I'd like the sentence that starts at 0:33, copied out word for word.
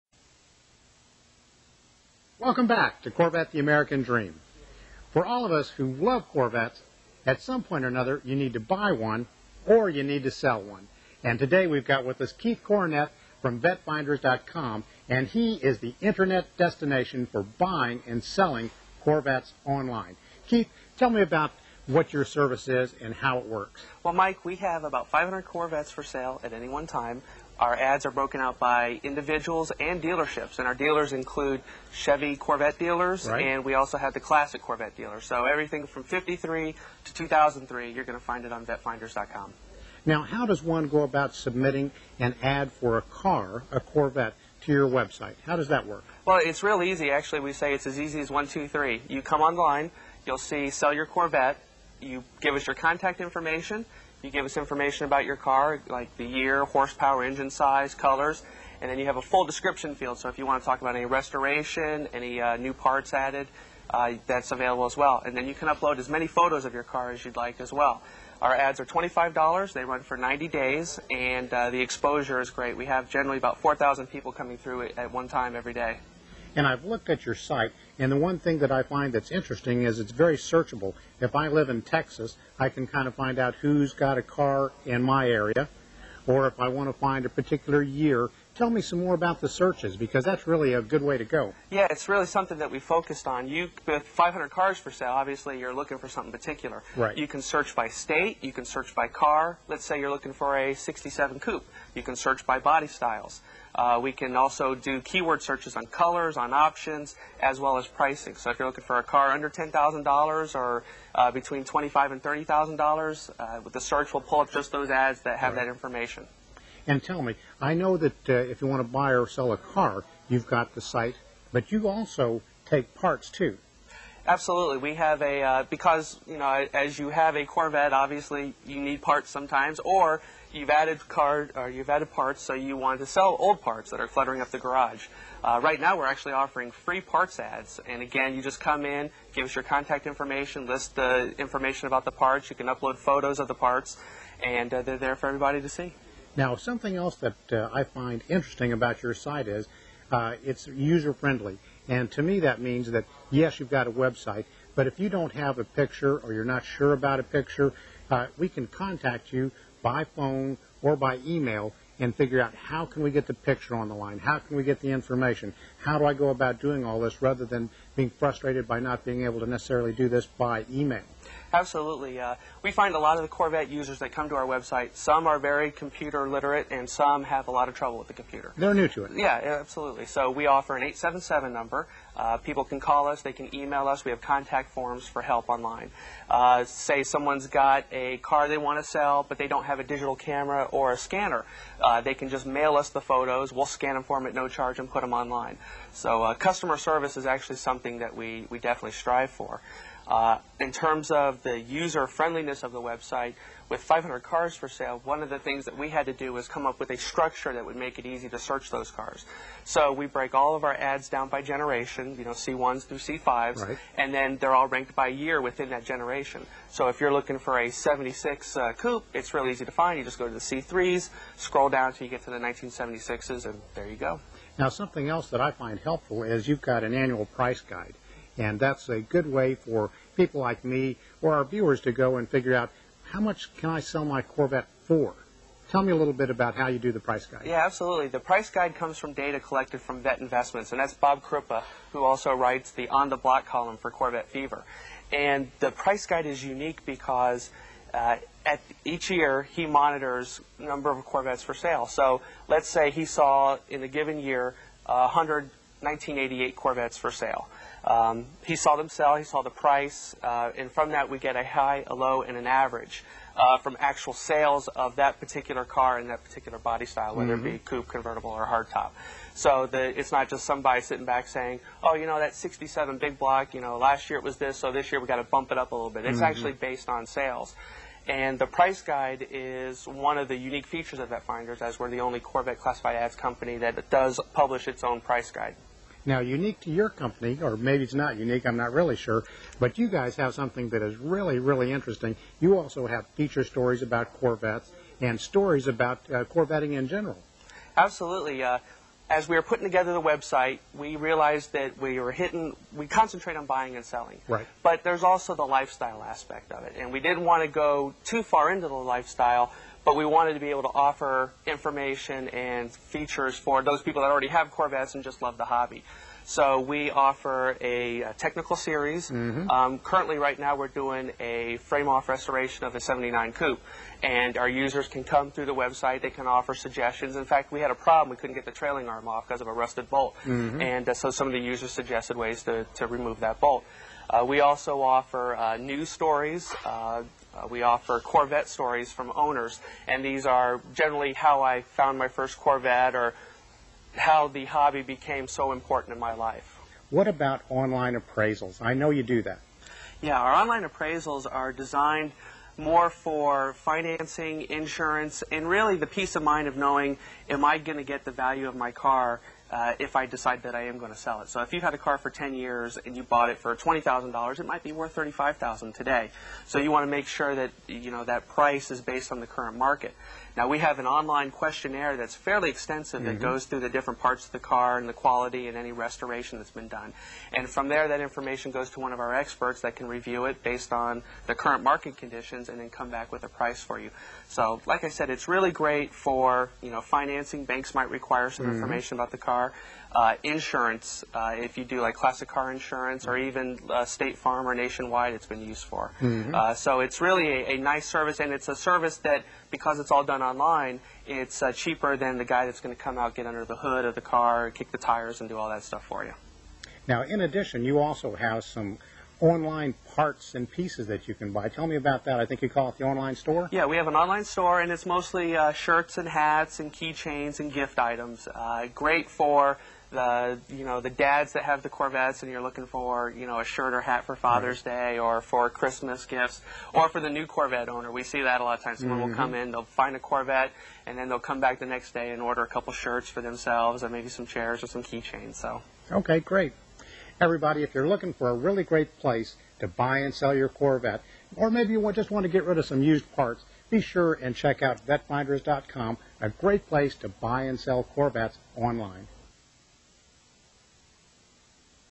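and we also have the classic Corvette dealers.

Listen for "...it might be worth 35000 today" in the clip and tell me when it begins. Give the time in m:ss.
6:04.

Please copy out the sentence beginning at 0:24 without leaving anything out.
Well, Mike, we have about 500 Corvettes for sale at any one time.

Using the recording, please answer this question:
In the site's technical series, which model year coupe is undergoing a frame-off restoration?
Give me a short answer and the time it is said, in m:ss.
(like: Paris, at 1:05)
1979, at 5:22.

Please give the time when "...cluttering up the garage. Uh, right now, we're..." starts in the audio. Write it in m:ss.
2:14.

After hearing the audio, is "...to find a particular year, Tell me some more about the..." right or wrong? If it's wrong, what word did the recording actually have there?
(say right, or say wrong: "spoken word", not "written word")
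right.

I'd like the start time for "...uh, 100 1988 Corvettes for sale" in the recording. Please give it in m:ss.
4:14.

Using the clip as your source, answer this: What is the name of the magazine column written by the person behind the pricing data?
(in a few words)
On the Block.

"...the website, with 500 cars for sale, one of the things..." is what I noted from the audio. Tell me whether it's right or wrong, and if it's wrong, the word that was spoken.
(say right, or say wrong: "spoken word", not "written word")
right.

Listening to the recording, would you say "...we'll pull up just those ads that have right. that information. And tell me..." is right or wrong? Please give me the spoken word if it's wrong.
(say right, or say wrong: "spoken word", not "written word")
right.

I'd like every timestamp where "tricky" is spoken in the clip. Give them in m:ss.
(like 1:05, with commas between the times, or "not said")
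not said.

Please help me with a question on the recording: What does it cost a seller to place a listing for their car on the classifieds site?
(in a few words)
$25.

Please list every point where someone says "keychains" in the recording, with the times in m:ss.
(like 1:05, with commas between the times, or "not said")
6:56, 7:14.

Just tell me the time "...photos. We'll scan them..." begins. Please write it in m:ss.
3:13.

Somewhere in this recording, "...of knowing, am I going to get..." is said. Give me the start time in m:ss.
5:56.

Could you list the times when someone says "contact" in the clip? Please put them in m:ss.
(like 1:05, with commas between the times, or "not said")
0:52, 2:19, 2:38, 3:04.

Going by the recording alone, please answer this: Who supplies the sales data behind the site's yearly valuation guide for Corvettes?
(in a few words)
Bob Krupa.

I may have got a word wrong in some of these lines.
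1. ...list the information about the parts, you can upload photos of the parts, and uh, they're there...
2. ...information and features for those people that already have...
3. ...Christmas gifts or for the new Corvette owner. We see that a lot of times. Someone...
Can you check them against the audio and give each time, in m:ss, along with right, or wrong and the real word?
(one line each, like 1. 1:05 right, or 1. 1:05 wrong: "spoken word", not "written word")
1. 2:20 right
2. 5:11 right
3. 7:05 right.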